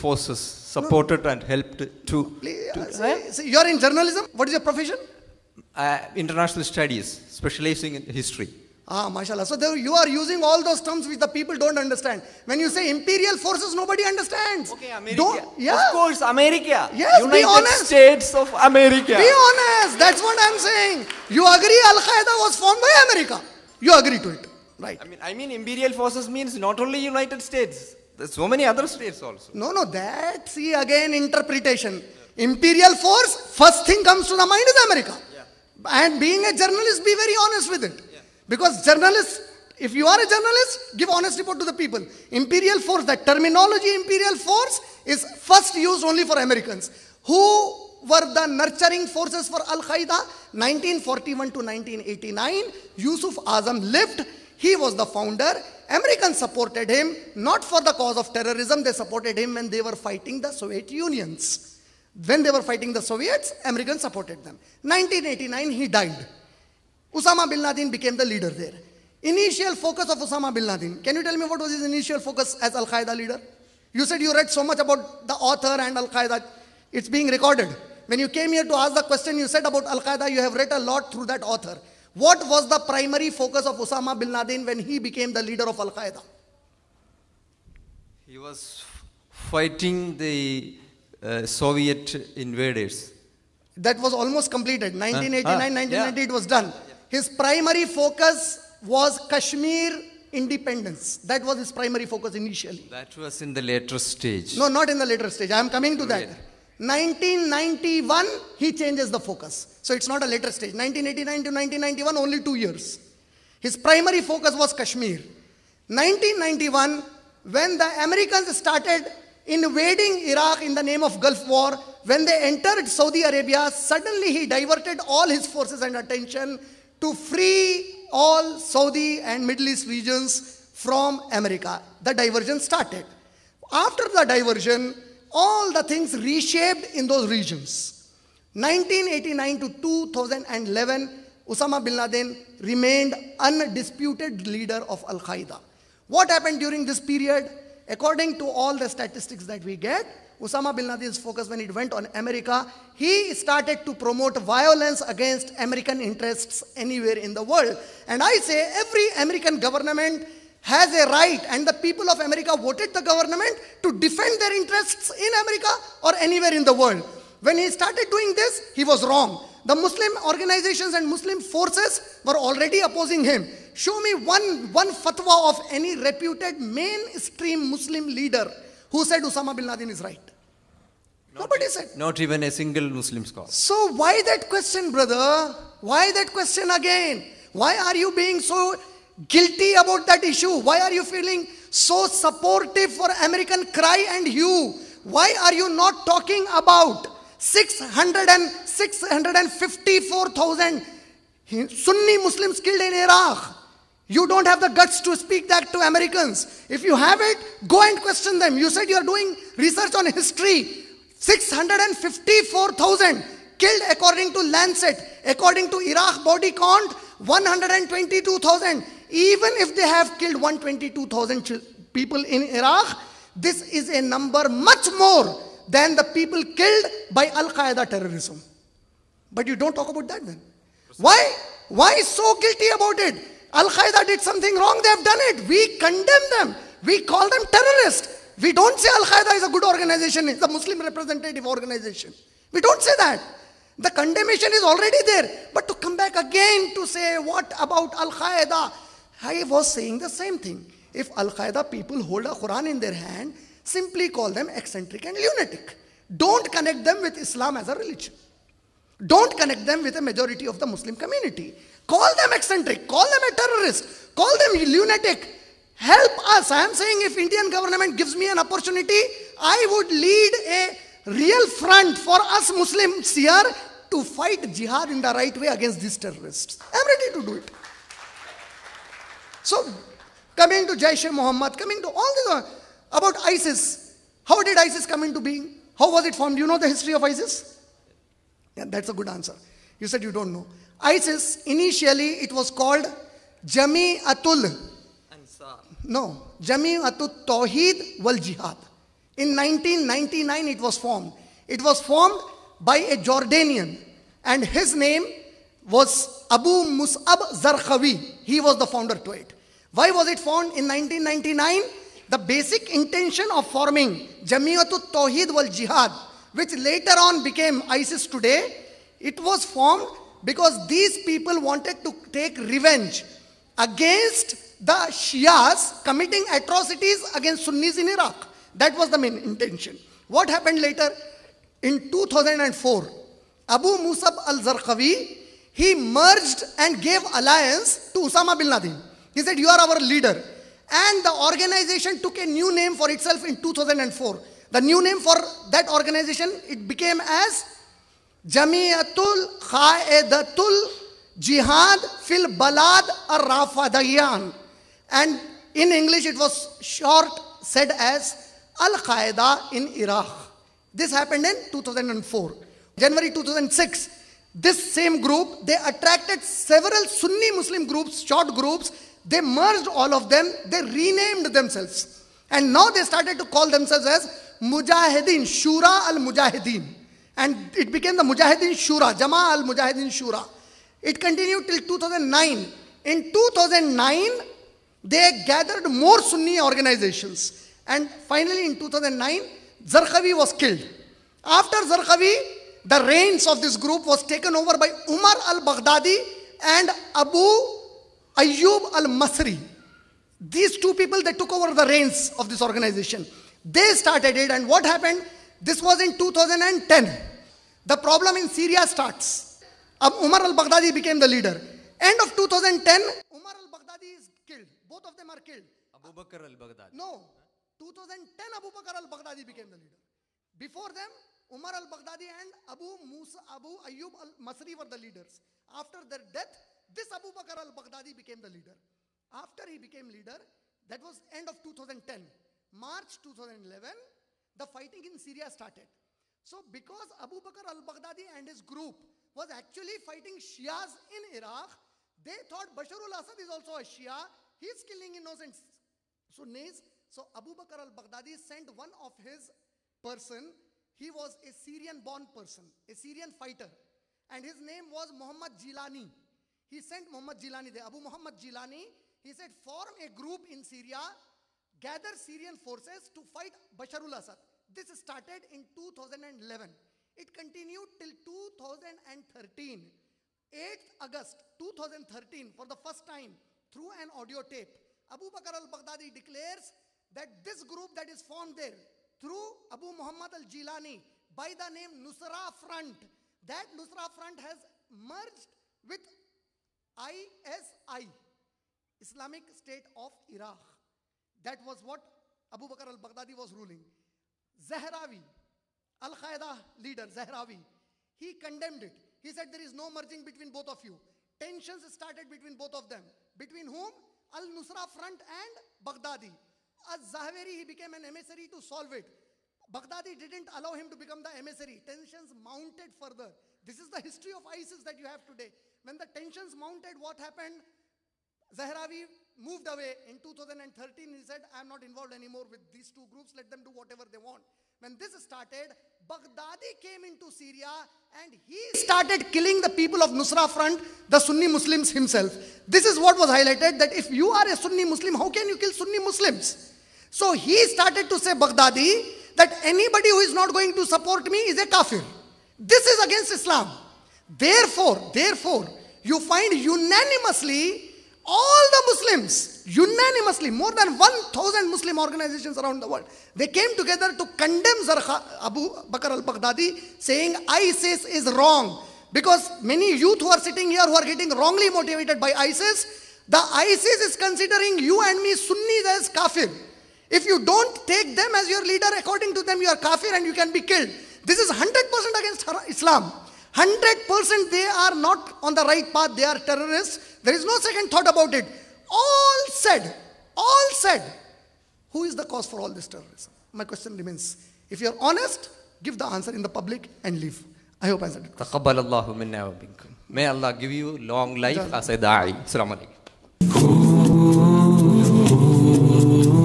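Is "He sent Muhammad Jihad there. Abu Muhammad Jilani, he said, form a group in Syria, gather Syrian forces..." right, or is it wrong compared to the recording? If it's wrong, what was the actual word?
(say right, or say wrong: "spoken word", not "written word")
wrong: "Jilani", not "Jihad".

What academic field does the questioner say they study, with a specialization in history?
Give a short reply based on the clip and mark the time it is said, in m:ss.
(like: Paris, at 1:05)
International studies, at 0:06.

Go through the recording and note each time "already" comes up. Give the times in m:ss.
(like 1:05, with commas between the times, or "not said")
2:52, 4:04.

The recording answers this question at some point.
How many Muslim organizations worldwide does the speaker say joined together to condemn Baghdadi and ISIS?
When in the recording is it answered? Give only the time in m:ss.
9:10.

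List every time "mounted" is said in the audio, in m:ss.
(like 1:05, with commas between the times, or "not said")
8:32, 8:36.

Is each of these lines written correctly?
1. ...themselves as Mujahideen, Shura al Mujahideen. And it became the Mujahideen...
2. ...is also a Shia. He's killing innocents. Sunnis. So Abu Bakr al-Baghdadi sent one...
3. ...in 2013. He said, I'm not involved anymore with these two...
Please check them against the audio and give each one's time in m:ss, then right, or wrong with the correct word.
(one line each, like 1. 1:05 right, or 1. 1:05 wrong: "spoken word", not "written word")
1. 6:13 right
2. 7:23 right
3. 8:39 right.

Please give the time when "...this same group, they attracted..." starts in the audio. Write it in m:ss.
6:04.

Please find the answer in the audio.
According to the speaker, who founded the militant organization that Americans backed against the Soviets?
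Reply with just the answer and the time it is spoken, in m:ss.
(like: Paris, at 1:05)
Yusuf Azzam, at 0:52.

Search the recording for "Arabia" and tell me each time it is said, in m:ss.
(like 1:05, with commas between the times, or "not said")
2:03.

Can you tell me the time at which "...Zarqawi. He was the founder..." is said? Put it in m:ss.
5:07.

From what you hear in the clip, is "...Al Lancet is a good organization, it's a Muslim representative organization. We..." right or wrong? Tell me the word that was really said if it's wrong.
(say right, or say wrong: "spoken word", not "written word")
wrong: "Qaeda", not "Lancet".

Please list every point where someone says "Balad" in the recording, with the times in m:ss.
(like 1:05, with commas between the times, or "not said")
5:52.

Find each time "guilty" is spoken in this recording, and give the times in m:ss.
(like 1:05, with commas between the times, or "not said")
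3:09, 3:52.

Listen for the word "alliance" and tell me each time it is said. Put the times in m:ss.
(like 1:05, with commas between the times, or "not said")
5:37.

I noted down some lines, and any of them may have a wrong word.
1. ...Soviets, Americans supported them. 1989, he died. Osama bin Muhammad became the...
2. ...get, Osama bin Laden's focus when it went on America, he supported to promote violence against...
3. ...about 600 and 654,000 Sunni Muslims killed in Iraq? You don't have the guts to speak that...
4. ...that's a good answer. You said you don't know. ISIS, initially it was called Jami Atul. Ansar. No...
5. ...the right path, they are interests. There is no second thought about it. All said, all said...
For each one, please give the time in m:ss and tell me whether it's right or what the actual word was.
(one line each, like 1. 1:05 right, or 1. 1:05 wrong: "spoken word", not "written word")
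1. 1:03 wrong: "Laden", not "Muhammad"
2. 2:29 wrong: "started", not "supported"
3. 3:16 right
4. 4:48 right
5. 9:35 wrong: "terrorists", not "interests".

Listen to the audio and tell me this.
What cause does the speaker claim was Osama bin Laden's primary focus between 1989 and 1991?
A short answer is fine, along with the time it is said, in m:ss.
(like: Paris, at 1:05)
Kashmir independence, at 1:39.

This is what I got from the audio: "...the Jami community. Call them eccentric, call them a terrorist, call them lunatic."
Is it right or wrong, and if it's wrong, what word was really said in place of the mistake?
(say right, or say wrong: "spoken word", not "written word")
wrong: "Muslim", not "Jami".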